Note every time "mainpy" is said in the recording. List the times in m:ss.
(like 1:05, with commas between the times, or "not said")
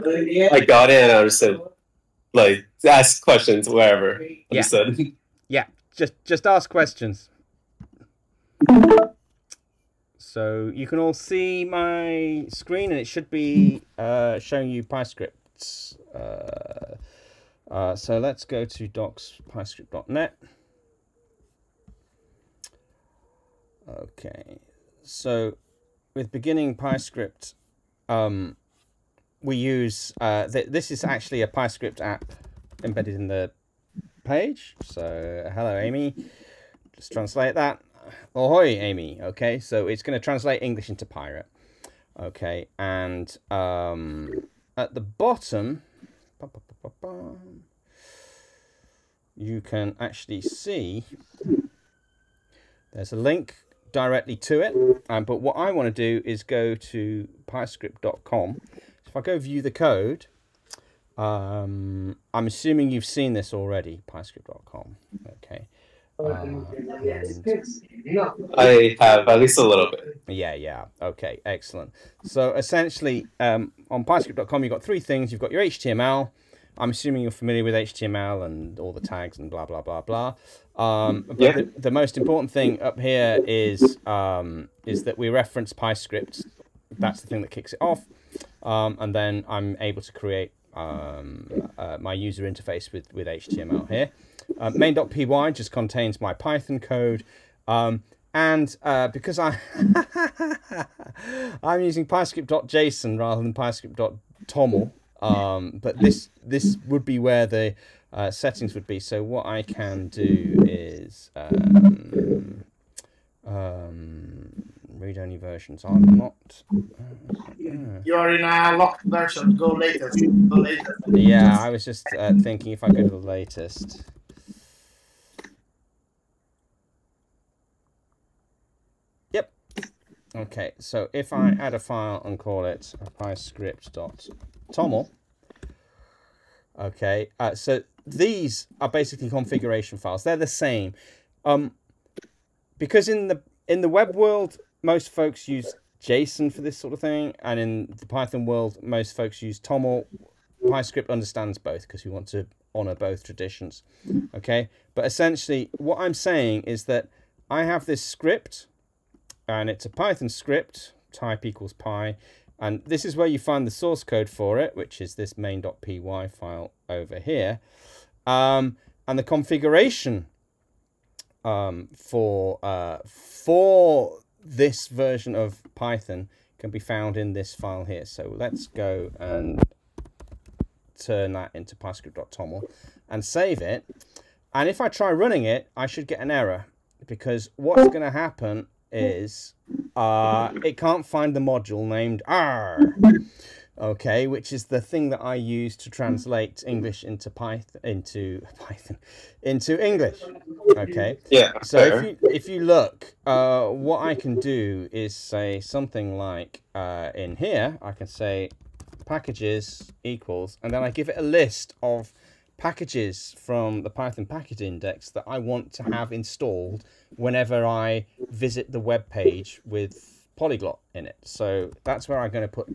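1:34, 2:45.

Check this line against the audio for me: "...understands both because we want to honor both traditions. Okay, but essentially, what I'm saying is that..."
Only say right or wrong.
right.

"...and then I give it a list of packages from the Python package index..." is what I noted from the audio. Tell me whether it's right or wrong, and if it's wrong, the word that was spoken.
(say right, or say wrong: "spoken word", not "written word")
right.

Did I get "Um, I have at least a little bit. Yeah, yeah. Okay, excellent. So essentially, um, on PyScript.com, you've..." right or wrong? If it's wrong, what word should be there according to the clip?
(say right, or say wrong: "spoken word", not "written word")
right.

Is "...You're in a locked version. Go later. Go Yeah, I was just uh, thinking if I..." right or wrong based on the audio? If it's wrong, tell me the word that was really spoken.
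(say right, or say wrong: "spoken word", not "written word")
right.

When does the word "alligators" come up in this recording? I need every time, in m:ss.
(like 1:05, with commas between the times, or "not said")
not said.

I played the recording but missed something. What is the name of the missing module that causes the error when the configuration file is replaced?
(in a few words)
arrr.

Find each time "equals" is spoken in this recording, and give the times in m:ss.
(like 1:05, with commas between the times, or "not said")
2:41, 3:30.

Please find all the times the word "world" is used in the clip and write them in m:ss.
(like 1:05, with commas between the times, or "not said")
2:24, 2:28.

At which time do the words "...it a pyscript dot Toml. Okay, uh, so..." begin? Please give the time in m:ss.
2:12.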